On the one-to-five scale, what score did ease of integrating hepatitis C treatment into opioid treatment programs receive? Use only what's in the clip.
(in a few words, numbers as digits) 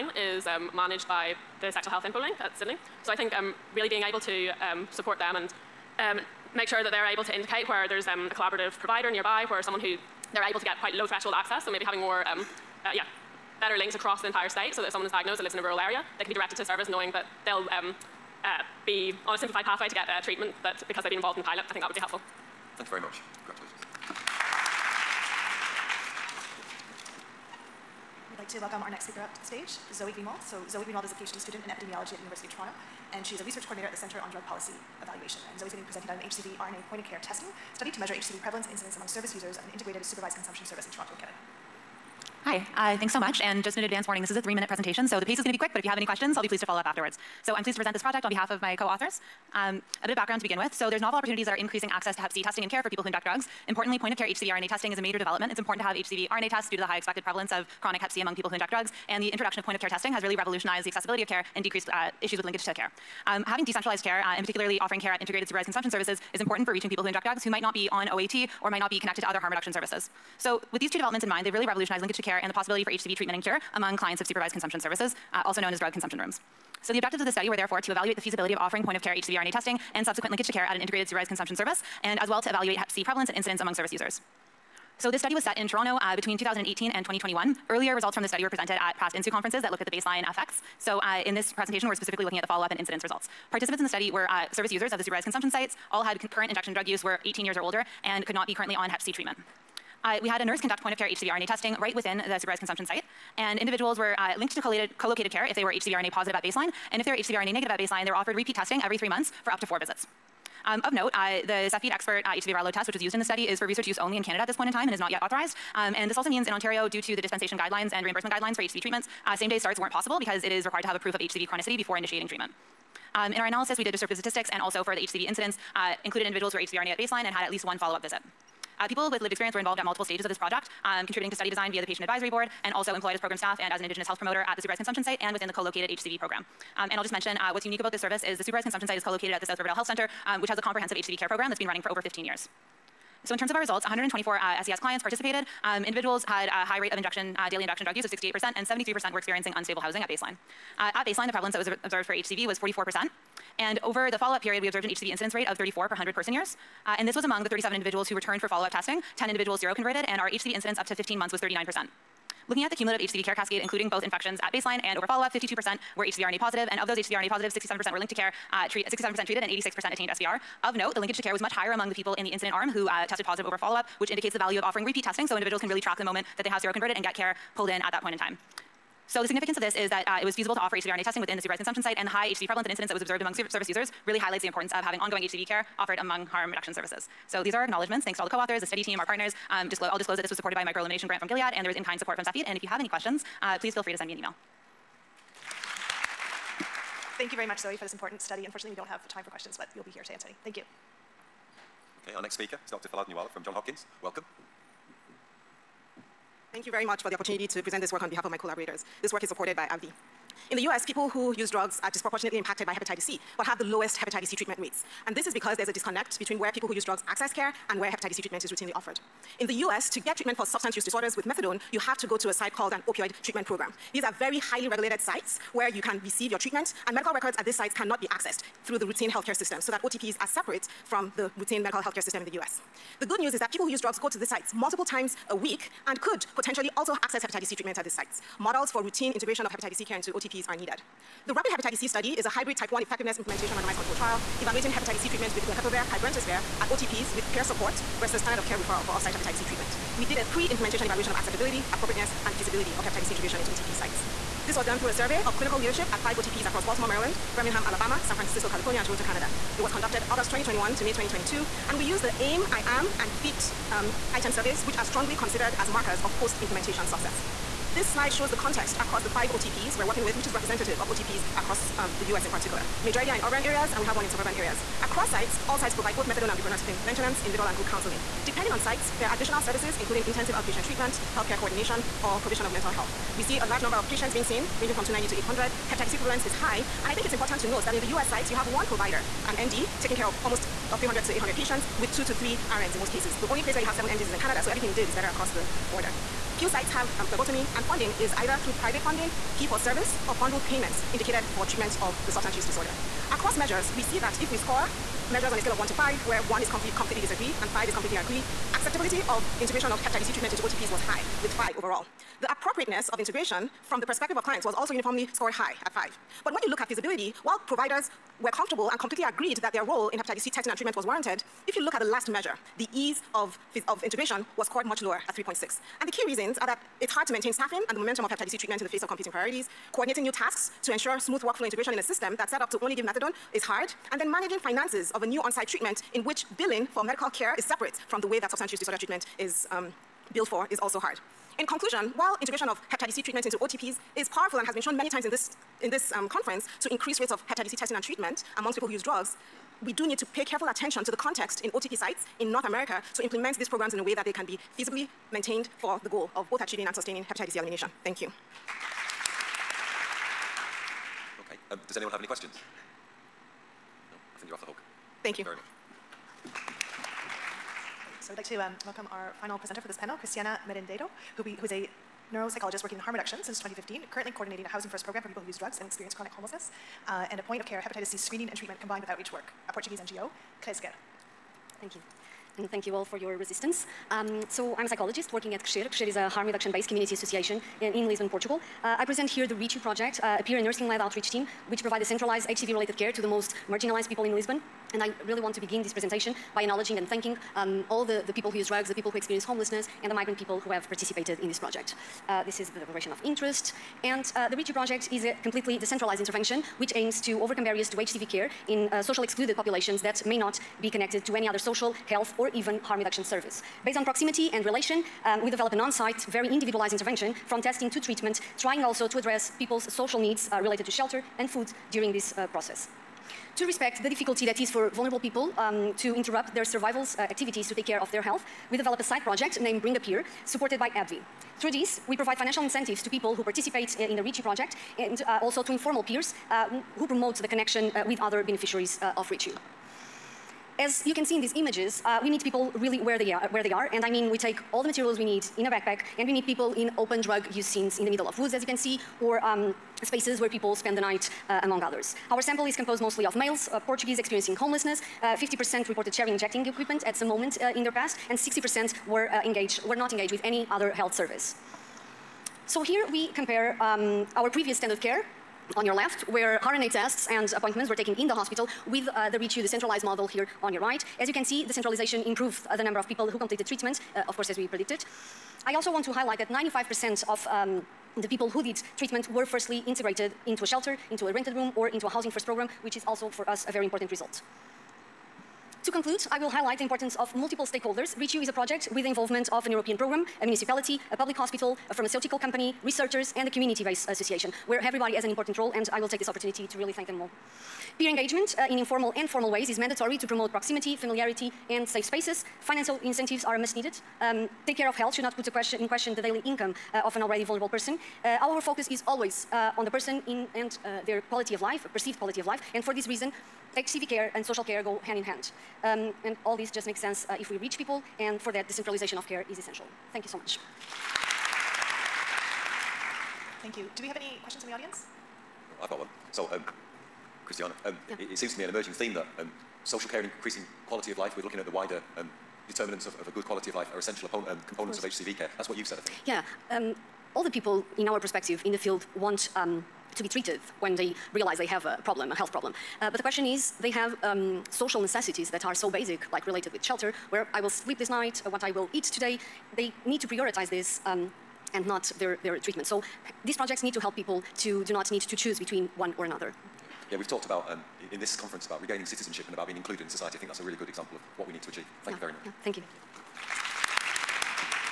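3.6.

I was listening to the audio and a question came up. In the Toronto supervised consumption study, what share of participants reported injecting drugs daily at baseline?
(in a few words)
68%.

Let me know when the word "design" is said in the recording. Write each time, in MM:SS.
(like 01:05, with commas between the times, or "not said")
02:11.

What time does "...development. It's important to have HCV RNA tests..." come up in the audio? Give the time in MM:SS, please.
00:55.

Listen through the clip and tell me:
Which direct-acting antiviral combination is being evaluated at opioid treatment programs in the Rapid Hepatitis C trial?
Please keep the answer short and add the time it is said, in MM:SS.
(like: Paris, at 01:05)
glecaprevir pibrentasvir, at 04:05.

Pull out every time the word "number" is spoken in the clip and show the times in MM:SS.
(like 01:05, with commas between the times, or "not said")
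04:43, 07:52.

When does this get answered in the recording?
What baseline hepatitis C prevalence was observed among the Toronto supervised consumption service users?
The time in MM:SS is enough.
02:32.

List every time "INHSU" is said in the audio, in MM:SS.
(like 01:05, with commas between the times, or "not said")
01:29.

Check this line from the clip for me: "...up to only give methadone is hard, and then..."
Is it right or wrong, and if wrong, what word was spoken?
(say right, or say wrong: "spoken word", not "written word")
right.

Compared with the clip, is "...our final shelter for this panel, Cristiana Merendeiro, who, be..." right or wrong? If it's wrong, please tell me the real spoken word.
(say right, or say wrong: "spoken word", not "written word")
wrong: "presenter", not "shelter".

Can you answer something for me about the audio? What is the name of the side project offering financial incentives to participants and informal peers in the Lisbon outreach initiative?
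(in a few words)
Bring a Peer.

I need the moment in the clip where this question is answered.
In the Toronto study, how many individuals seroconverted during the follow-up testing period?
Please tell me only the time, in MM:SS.
02:39.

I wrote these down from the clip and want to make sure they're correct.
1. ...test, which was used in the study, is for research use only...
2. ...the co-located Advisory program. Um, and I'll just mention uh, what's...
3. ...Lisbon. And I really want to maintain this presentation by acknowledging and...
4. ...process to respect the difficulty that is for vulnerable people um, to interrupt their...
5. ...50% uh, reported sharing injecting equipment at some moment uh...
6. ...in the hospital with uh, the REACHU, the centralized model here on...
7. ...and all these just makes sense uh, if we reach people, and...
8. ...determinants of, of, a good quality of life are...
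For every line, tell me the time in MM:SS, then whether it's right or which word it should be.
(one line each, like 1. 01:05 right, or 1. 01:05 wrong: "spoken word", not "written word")
1. 01:52 right
2. 02:15 wrong: "HCV", not "Advisory"
3. 06:34 wrong: "begin", not "maintain"
4. 07:02 right
5. 07:35 right
6. 07:47 right
7. 08:36 right
8. 08:52 right.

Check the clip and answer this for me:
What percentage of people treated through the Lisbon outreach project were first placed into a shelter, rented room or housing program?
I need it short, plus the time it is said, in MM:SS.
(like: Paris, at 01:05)
95%, at 07:56.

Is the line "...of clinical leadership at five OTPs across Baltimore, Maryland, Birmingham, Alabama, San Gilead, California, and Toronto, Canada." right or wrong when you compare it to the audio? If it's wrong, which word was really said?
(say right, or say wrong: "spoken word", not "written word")
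wrong: "Francisco", not "Gilead".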